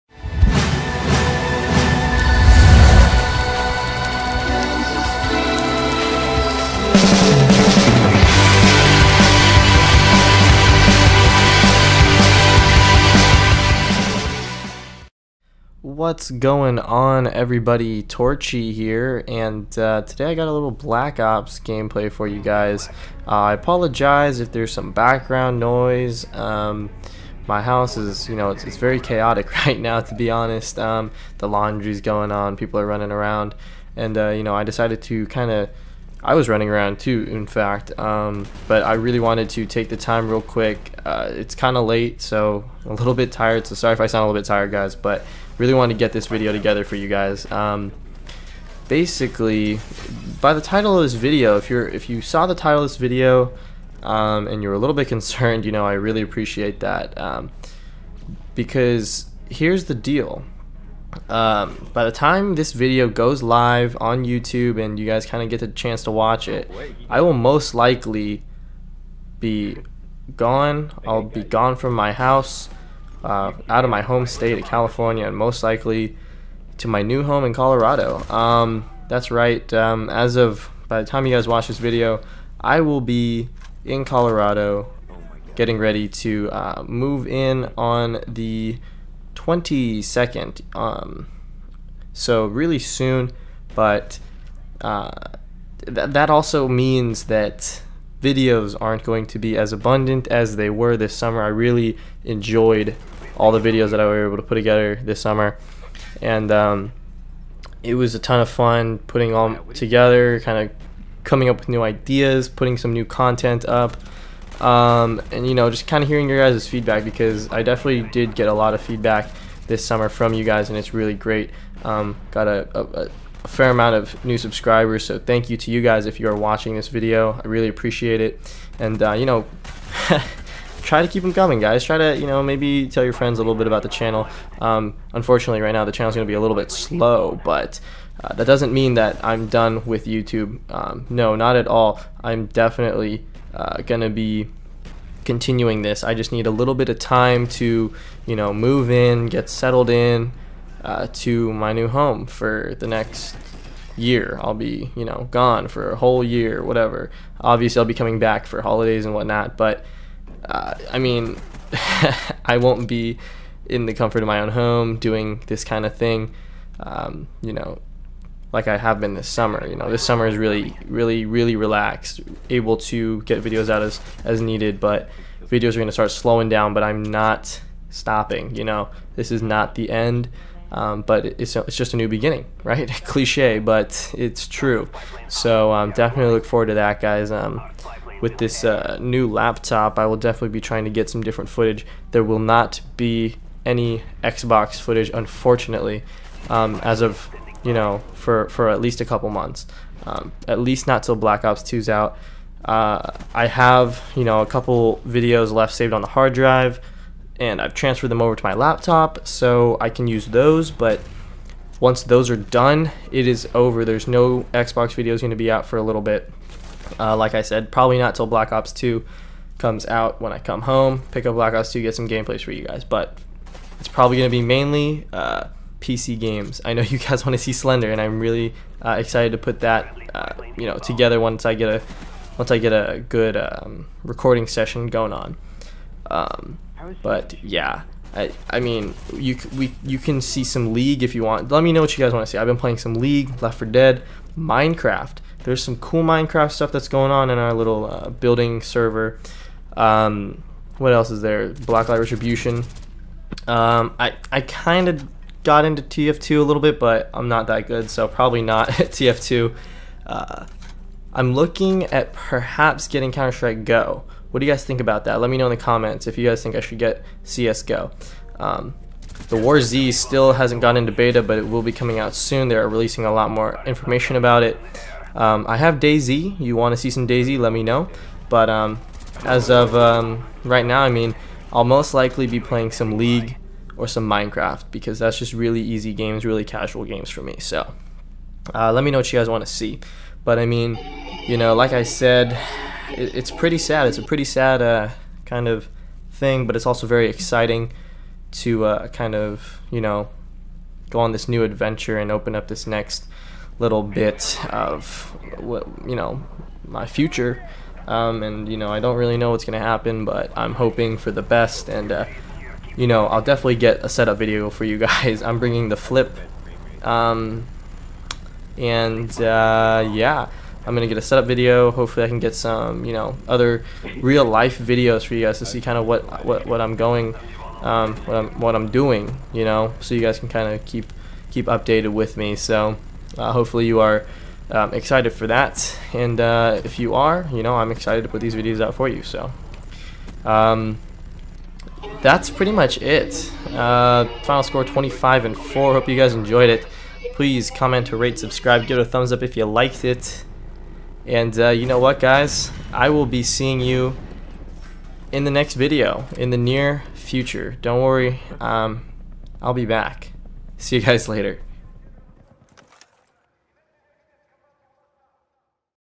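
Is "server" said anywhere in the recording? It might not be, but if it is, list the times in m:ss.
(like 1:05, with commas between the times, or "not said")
4:08.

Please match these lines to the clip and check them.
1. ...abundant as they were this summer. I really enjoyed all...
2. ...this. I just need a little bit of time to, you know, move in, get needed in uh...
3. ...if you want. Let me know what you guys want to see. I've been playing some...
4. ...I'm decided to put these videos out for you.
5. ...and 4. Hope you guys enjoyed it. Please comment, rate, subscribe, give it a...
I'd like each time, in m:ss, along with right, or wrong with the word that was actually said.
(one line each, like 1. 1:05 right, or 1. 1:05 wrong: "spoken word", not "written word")
1. 1:39 right
2. 2:25 wrong: "settled", not "needed"
3. 4:01 right
4. 5:37 wrong: "excited", not "decided"
5. 5:45 right.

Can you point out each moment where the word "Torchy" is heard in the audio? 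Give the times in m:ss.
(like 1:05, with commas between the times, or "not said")
0:18.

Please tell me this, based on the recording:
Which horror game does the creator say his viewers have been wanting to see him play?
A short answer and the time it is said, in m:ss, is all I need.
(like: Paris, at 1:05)
Slender, at 3:47.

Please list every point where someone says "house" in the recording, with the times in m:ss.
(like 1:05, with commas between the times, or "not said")
0:27, 1:12.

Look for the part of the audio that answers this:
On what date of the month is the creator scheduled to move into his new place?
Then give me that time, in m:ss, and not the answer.
1:29.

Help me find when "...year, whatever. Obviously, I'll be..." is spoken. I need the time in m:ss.
2:36.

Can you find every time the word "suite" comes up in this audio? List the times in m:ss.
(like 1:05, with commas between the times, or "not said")
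not said.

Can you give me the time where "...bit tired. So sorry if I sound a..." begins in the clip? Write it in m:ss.
0:43.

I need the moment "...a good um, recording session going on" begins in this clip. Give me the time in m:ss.
3:52.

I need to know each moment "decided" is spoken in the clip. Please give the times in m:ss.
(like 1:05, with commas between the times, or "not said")
0:34.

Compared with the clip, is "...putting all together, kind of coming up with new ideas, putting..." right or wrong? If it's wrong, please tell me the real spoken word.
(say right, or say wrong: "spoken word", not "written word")
right.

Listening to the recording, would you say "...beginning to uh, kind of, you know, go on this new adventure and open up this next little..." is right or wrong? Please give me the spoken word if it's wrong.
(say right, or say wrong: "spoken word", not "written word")
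wrong: "exciting", not "beginning".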